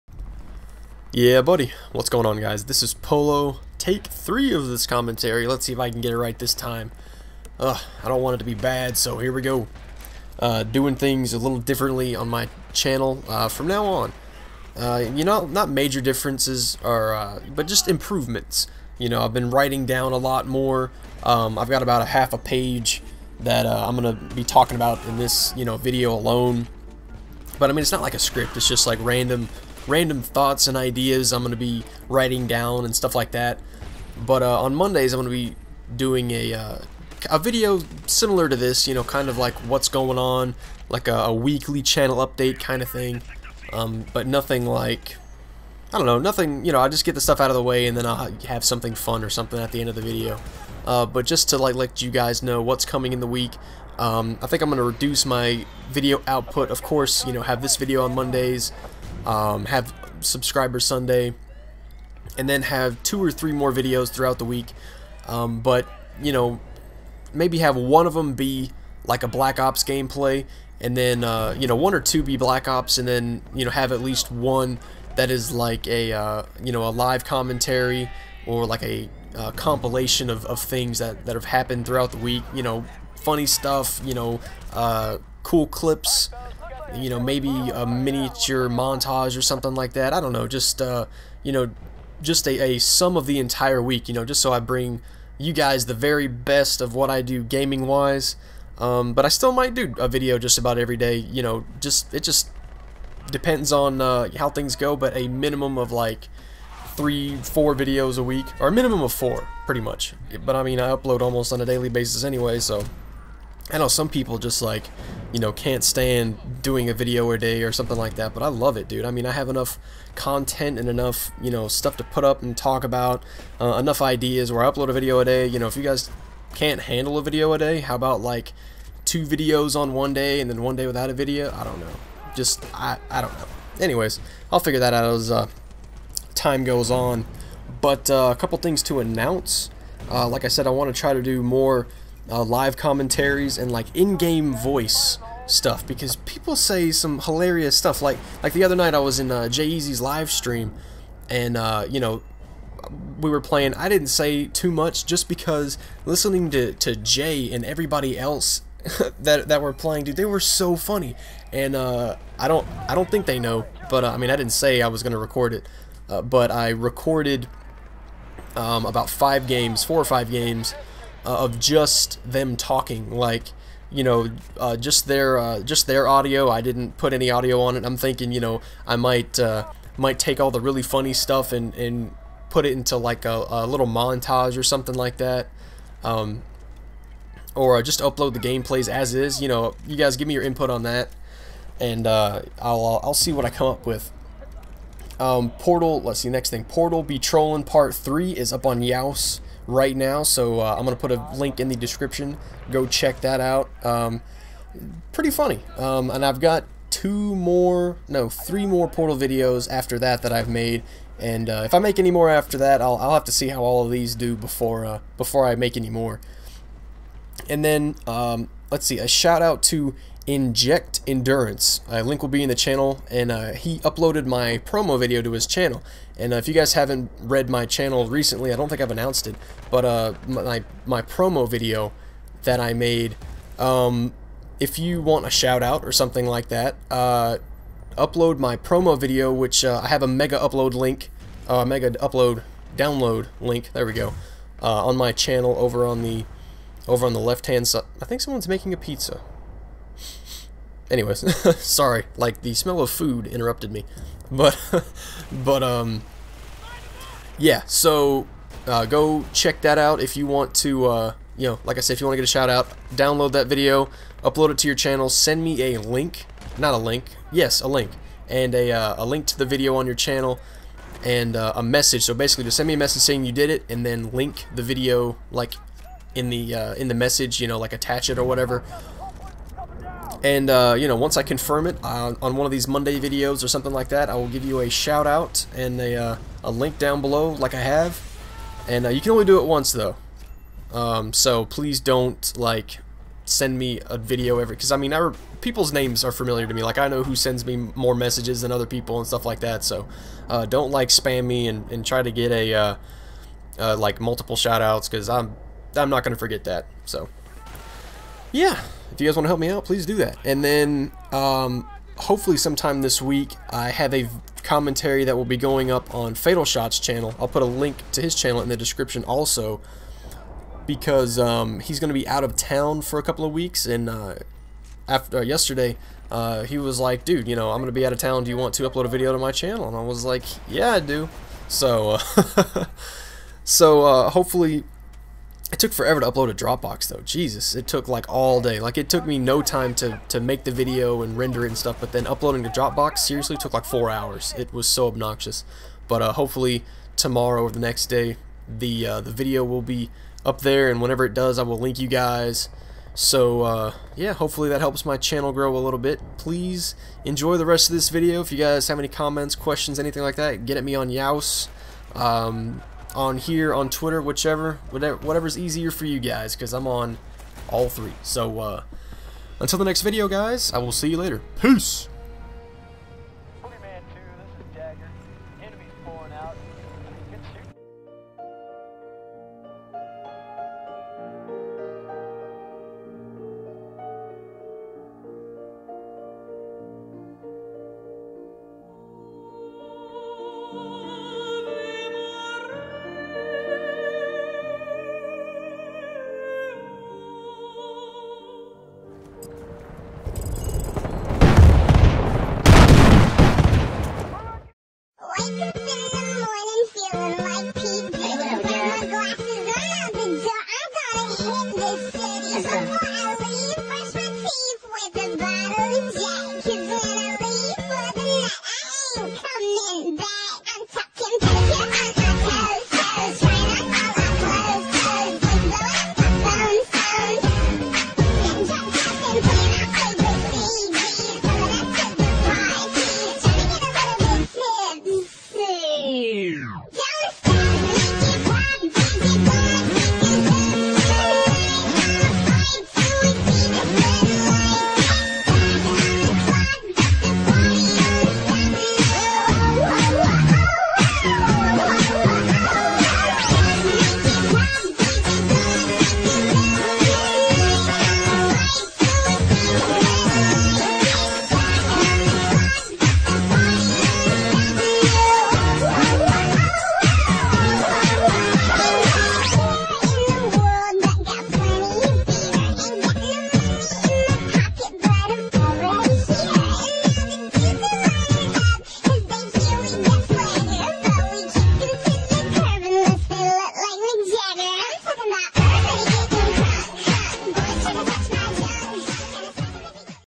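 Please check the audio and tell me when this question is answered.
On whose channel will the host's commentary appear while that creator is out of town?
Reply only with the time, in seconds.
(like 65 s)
316 s.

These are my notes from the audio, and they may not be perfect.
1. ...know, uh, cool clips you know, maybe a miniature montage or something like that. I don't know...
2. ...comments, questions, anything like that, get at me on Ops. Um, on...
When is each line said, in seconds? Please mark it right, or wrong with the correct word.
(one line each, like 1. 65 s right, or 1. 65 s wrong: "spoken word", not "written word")
1. 84 s right
2. 358 s wrong: "Yeousch", not "Ops".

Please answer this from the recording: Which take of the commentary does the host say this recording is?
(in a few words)
3.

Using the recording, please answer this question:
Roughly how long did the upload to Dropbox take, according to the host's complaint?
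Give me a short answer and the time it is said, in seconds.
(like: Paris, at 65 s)
4 hours, at 343 s.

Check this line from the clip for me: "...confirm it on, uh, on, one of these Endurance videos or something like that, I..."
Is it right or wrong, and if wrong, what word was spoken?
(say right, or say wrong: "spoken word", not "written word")
wrong: "Monday", not "Endurance".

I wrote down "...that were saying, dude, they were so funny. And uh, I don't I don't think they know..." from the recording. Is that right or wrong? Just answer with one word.
wrong.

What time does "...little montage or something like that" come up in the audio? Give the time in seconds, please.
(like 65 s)
183 s.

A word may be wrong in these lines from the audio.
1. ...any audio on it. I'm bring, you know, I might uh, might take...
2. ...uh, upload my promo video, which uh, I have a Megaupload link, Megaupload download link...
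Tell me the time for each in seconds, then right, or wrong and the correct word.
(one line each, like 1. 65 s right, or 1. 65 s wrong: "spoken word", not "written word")
1. 177 s wrong: "thinking", not "bring"
2. 236 s right.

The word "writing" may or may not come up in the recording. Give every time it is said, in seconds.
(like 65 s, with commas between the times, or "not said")
19 s, 32 s.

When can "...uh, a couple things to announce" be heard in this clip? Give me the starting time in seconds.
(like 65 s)
138 s.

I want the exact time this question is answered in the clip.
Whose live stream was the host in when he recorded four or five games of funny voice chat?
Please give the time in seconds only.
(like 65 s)
149 s.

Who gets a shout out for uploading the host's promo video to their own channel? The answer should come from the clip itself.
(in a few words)
Eject Endurance.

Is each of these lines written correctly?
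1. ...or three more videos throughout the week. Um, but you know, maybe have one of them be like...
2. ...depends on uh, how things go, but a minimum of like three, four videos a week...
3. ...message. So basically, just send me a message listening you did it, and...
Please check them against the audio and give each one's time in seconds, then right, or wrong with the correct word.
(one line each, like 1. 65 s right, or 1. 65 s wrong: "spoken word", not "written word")
1. 63 s right
2. 103 s right
3. 271 s wrong: "saying", not "listening".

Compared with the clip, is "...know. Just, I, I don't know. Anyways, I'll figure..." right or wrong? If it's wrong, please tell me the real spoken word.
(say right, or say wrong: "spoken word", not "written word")
right.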